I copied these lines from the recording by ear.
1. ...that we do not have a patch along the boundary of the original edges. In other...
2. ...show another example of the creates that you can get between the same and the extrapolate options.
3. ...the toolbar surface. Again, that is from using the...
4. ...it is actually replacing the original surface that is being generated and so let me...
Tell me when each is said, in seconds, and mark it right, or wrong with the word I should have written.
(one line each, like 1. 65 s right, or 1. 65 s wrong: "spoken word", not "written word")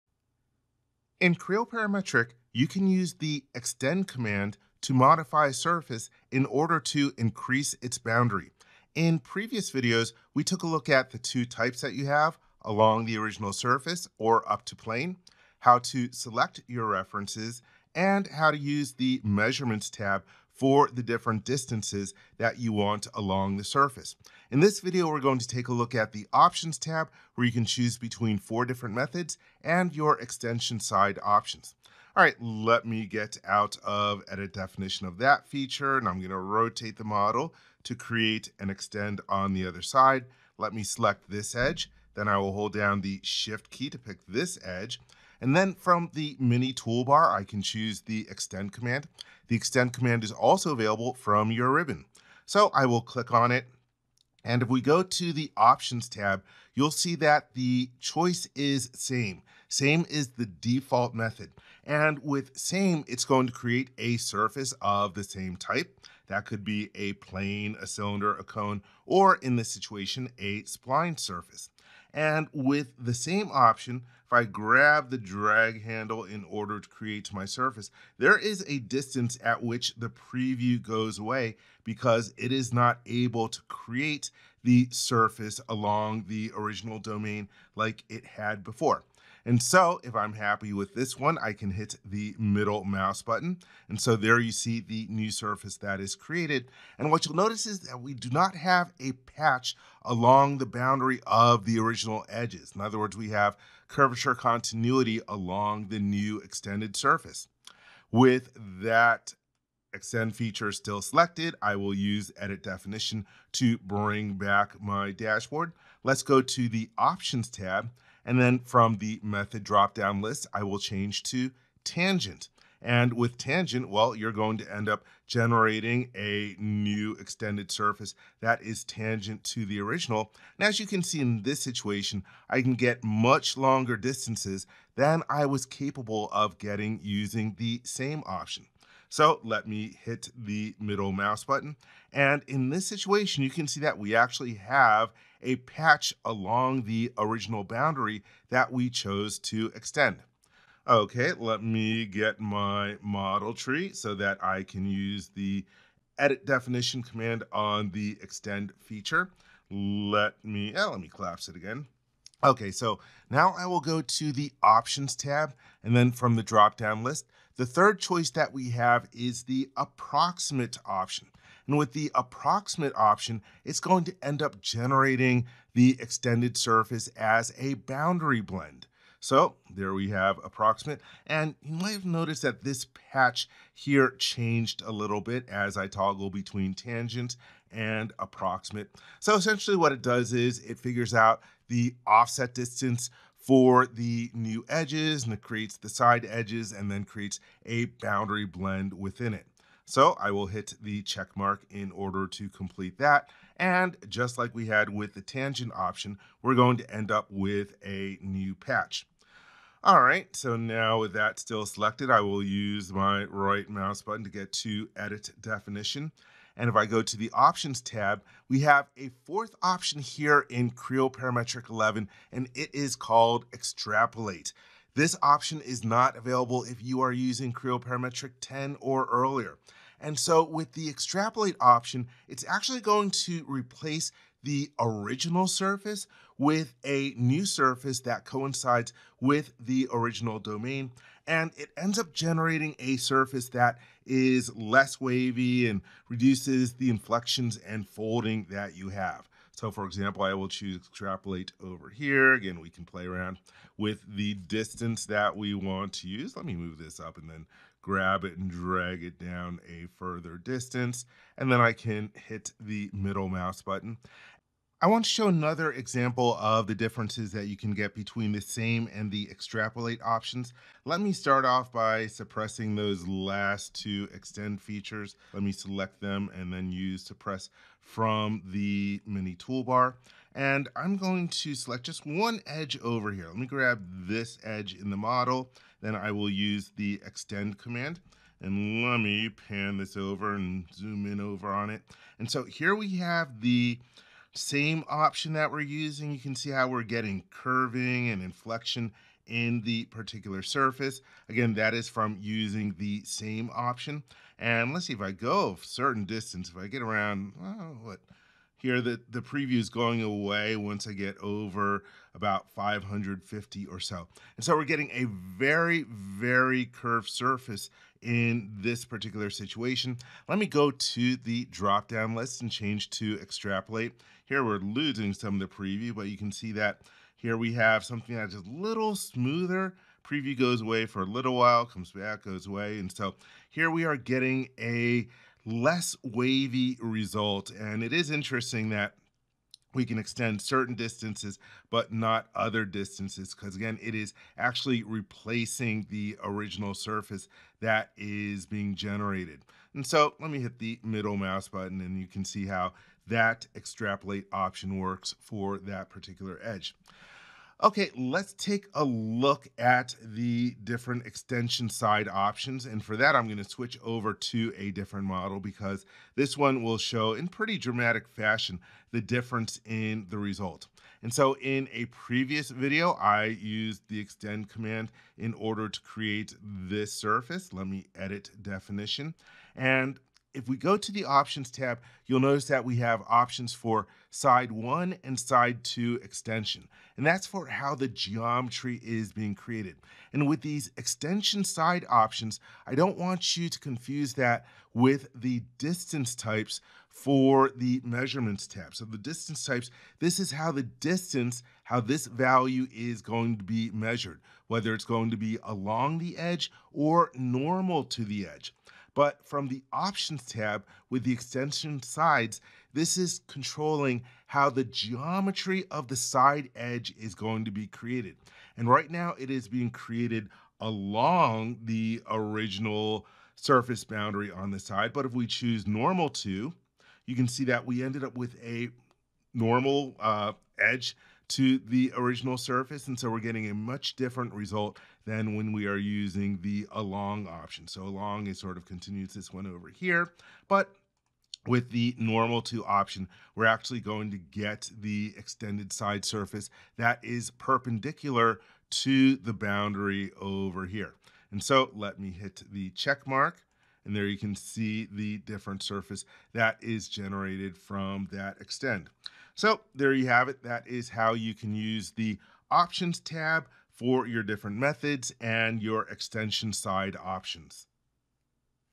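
1. 97 s right
2. 265 s wrong: "differences", not "creates"
3. 299 s wrong: "particular", not "toolbar"
4. 343 s right.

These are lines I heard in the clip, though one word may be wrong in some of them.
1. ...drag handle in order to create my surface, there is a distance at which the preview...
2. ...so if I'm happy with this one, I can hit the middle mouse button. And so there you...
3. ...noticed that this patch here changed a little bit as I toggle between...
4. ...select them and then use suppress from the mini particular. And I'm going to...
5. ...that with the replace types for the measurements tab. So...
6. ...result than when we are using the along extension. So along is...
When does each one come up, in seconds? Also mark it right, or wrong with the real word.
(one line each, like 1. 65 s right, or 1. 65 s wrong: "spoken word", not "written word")
1. 75 s right
2. 89 s right
3. 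182 s right
4. 275 s wrong: "toolbar", not "particular"
5. 394 s wrong: "distance", not "replace"
6. 434 s wrong: "option", not "extension".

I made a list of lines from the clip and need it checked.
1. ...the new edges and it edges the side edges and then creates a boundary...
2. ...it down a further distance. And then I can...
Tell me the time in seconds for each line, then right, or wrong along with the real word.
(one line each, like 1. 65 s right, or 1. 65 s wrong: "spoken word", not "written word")
1. 193 s wrong: "creates", not "edges"
2. 259 s right.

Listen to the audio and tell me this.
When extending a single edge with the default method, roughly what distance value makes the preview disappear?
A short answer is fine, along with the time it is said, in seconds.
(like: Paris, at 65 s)
550, at 312 s.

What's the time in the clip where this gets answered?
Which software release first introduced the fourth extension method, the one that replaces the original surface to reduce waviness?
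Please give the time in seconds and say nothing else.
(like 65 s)
220 s.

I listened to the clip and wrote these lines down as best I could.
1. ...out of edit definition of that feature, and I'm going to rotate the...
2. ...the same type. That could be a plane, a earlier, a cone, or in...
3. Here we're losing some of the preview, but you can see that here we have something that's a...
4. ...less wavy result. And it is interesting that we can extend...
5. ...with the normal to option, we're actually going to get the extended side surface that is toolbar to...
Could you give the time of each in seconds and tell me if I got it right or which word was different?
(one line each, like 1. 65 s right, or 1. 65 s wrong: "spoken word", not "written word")
1. 33 s right
2. 65 s wrong: "cylinder", not "earlier"
3. 324 s right
4. 335 s right
5. 441 s wrong: "perpendicular", not "toolbar".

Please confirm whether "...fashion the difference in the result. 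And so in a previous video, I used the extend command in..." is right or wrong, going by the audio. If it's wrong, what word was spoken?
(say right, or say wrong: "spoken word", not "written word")
right.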